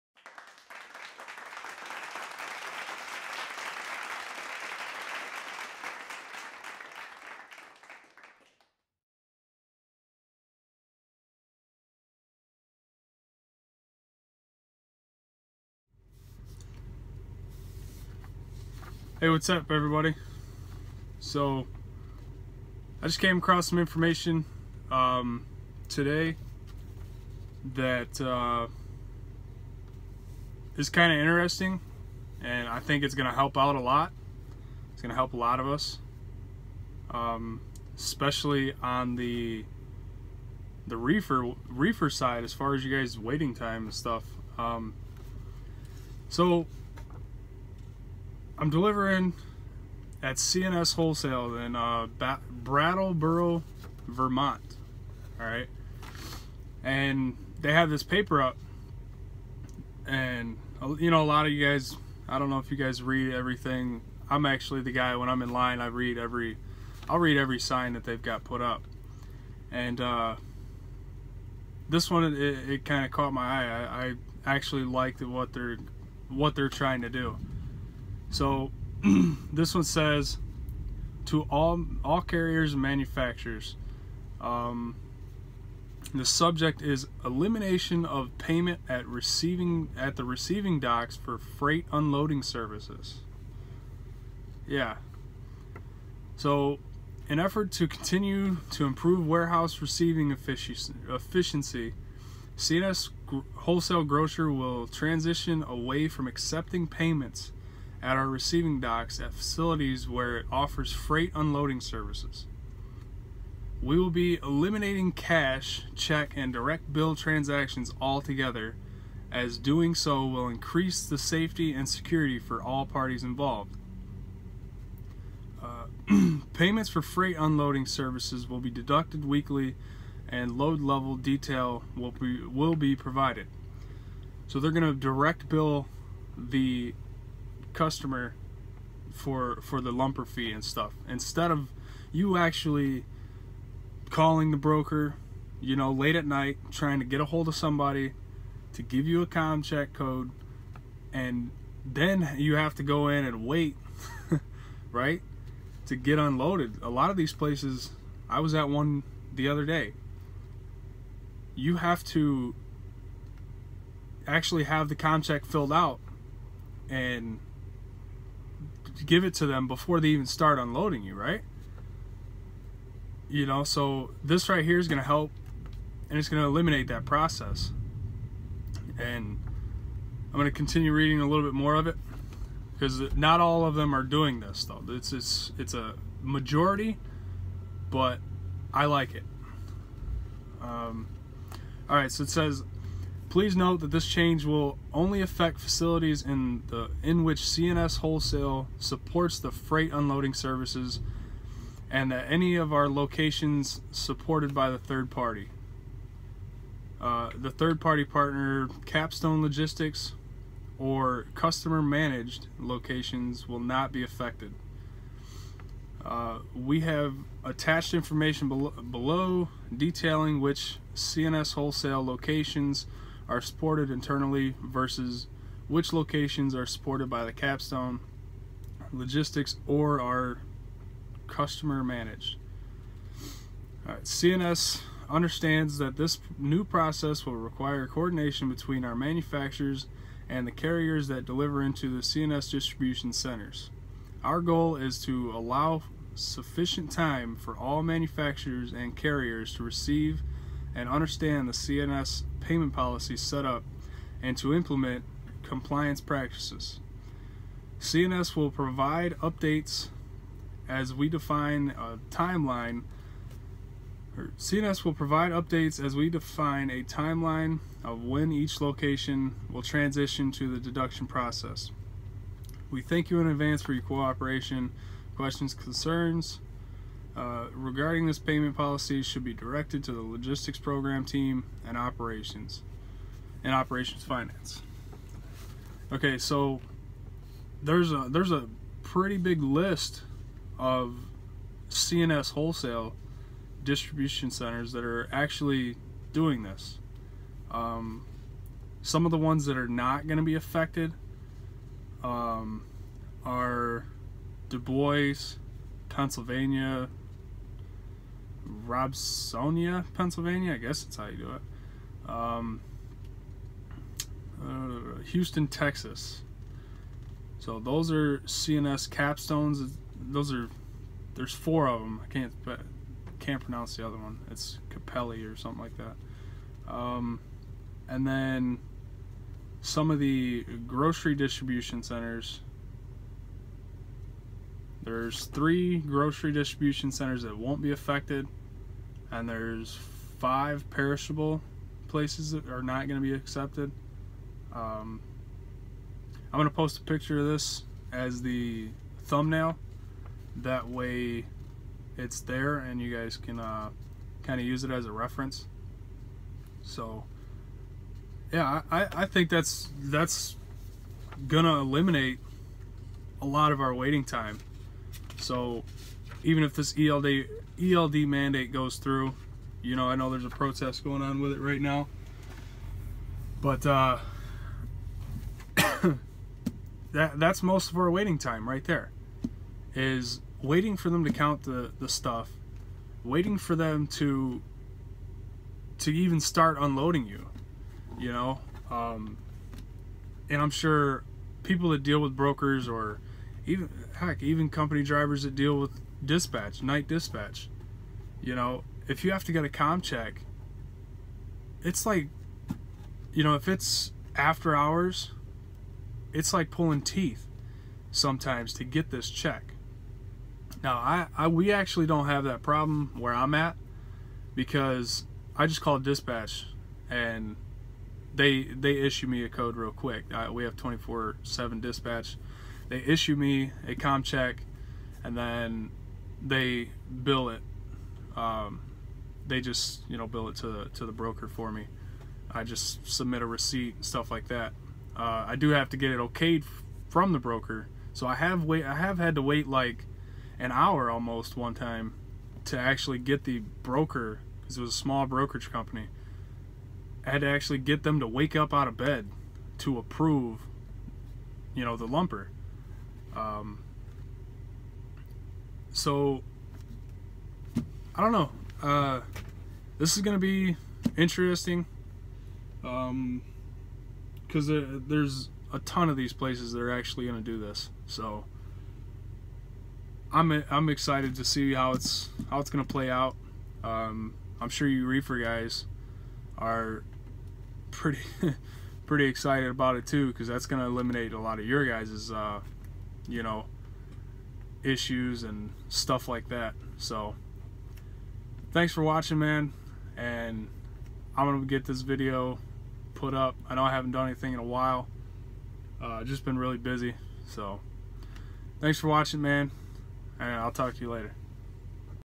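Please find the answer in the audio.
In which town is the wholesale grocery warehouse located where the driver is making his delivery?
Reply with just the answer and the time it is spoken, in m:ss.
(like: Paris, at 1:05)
Brattleboro, Vermont, at 0:52.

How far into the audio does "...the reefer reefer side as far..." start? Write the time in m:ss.
0:40.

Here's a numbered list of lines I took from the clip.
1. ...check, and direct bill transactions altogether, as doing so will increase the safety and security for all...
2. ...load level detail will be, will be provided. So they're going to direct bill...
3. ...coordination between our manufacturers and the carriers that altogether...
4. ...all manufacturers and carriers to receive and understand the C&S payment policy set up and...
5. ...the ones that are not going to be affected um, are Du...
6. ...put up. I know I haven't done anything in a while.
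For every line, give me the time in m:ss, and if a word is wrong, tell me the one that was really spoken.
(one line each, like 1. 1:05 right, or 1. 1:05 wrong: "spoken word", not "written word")
1. 1:55 right
2. 2:10 right
3. 3:57 wrong: "deliver", not "altogether"
4. 4:07 right
5. 4:59 right
6. 8:12 right.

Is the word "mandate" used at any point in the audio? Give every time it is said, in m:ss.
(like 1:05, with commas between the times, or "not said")
6:08.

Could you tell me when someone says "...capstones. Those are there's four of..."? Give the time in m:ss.
5:18.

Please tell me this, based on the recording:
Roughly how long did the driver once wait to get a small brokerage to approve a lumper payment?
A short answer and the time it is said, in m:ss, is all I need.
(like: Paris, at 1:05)
An hour, at 7:20.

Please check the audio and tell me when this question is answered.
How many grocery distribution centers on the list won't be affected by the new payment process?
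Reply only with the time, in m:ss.
5:35.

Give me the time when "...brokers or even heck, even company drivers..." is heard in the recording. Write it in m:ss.
6:32.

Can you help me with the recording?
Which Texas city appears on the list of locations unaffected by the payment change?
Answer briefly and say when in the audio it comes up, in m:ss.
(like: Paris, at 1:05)
Houston, at 5:15.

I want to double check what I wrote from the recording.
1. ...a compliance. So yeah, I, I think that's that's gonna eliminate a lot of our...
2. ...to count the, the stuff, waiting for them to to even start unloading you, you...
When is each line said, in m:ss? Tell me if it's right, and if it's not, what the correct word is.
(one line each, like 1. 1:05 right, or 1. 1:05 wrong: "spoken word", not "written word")
1. 5:54 wrong: "reference", not "compliance"
2. 6:21 right.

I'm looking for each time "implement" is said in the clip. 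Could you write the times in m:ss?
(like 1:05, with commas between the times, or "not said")
4:14.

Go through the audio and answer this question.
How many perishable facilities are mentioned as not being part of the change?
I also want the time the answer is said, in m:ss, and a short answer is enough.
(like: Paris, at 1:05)
5, at 5:40.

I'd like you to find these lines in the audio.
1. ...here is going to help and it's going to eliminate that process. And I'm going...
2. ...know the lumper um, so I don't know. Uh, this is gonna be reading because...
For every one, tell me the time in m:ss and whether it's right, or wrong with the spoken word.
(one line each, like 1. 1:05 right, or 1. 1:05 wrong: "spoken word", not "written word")
1. 2:54 right
2. 7:31 wrong: "interesting", not "reading".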